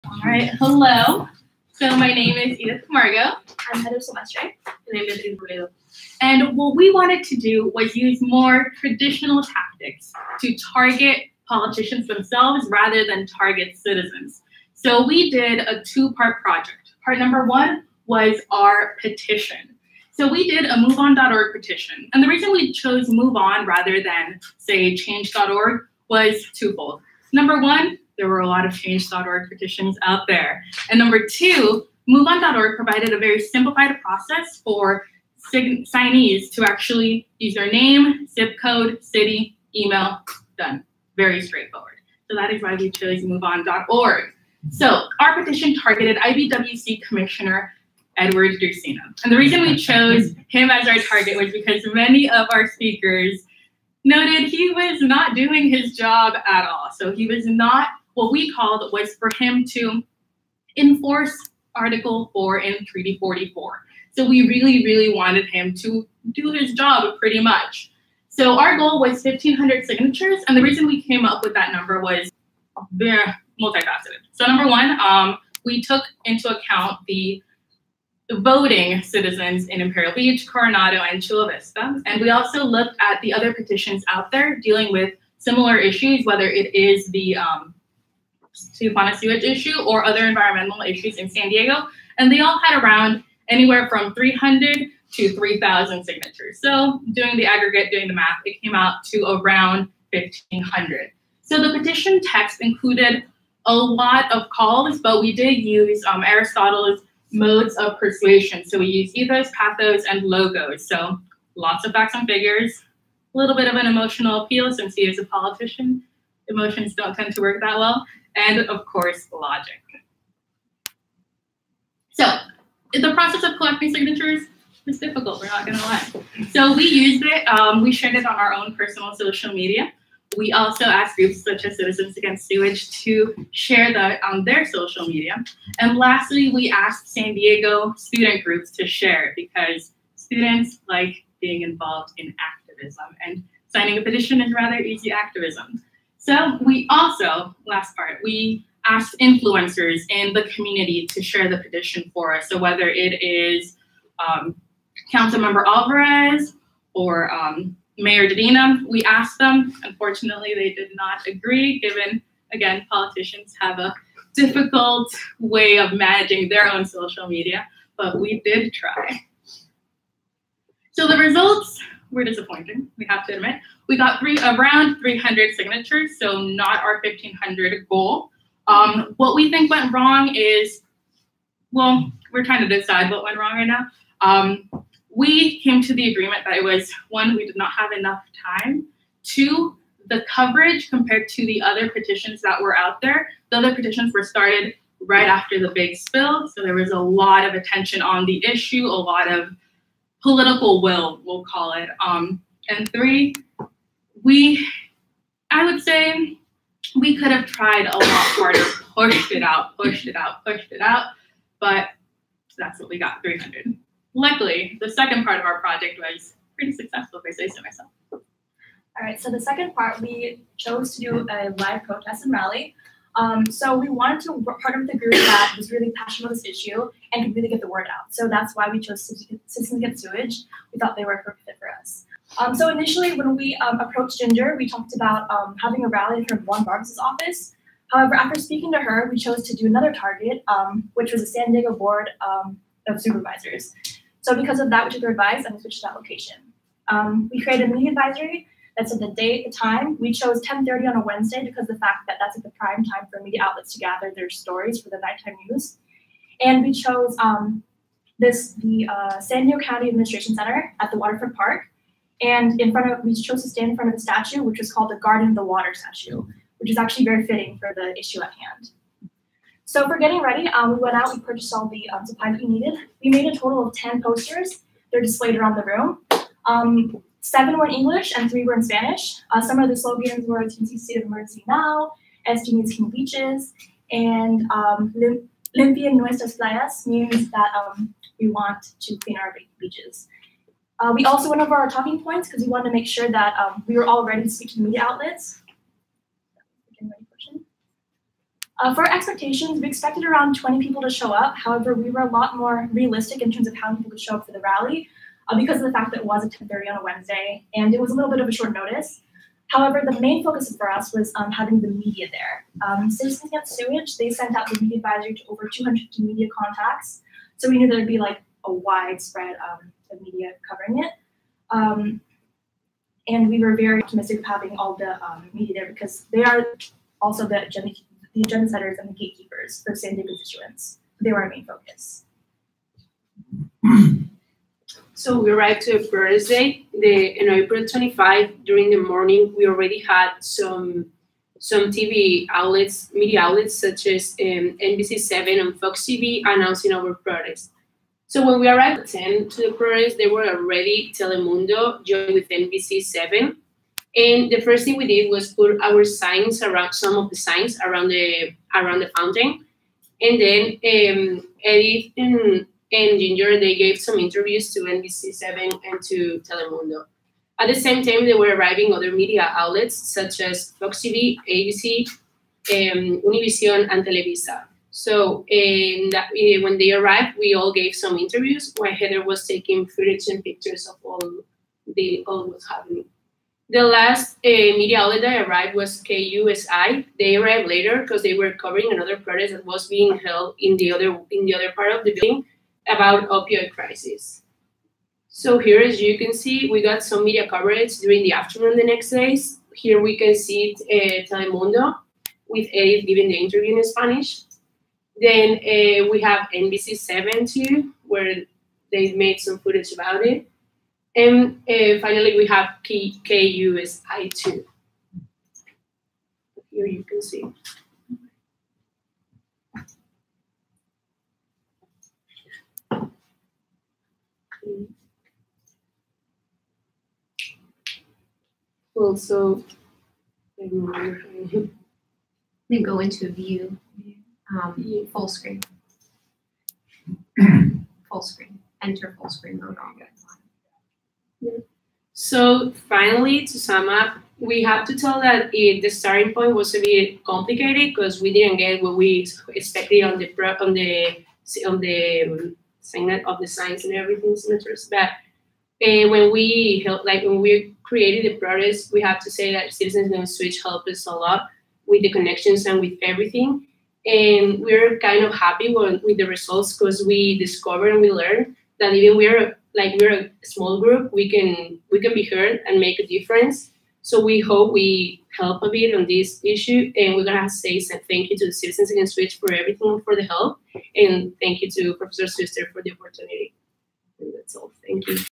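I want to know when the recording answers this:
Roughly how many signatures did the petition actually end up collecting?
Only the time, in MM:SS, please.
02:54.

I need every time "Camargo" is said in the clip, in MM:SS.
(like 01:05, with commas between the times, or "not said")
00:02.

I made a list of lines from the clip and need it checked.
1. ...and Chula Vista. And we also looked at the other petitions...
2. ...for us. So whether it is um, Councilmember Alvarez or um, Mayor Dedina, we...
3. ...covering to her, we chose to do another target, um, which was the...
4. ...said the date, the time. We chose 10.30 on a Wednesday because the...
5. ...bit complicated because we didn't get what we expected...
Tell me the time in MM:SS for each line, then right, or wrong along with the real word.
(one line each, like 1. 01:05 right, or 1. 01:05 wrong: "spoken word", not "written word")
1. 01:20 right
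2. 02:32 right
3. 03:58 wrong: "speaking", not "covering"
4. 04:08 right
5. 07:26 right.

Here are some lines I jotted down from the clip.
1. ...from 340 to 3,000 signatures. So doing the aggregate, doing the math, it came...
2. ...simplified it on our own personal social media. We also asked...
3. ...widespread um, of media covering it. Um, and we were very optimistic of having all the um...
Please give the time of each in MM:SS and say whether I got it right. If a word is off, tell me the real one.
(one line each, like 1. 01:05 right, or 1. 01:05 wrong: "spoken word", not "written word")
1. 01:33 wrong: "300", not "340"
2. 02:07 wrong: "shared", not "simplified"
3. 05:18 right.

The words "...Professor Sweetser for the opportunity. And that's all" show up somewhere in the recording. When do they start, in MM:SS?
08:01.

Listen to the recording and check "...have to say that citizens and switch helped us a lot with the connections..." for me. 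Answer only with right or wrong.
right.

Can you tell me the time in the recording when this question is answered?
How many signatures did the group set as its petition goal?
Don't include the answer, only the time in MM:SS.
01:09.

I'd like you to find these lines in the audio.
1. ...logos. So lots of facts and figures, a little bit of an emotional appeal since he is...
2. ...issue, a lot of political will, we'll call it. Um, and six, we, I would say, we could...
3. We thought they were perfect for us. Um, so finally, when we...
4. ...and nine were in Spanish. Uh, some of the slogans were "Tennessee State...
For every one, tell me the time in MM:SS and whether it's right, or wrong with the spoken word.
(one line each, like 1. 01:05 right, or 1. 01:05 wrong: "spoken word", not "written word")
1. 01:50 right
2. 03:18 wrong: "three", not "six"
3. 03:50 wrong: "initially", not "finally"
4. 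04:38 wrong: "three", not "nine".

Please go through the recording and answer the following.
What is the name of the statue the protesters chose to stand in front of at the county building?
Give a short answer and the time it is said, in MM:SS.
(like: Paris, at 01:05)
Guardian of the Water, at 04:24.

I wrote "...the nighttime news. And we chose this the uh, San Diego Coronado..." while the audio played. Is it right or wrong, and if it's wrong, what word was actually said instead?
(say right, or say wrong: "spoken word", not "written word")
wrong: "County", not "Coronado".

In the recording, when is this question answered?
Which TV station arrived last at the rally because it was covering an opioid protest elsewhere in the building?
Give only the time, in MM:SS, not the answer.
06:25.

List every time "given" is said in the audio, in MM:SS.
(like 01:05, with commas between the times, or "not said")
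02:41.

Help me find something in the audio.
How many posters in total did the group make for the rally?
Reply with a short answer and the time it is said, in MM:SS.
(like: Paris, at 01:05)
10, at 04:33.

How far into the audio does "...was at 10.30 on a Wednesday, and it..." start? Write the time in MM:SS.
05:06.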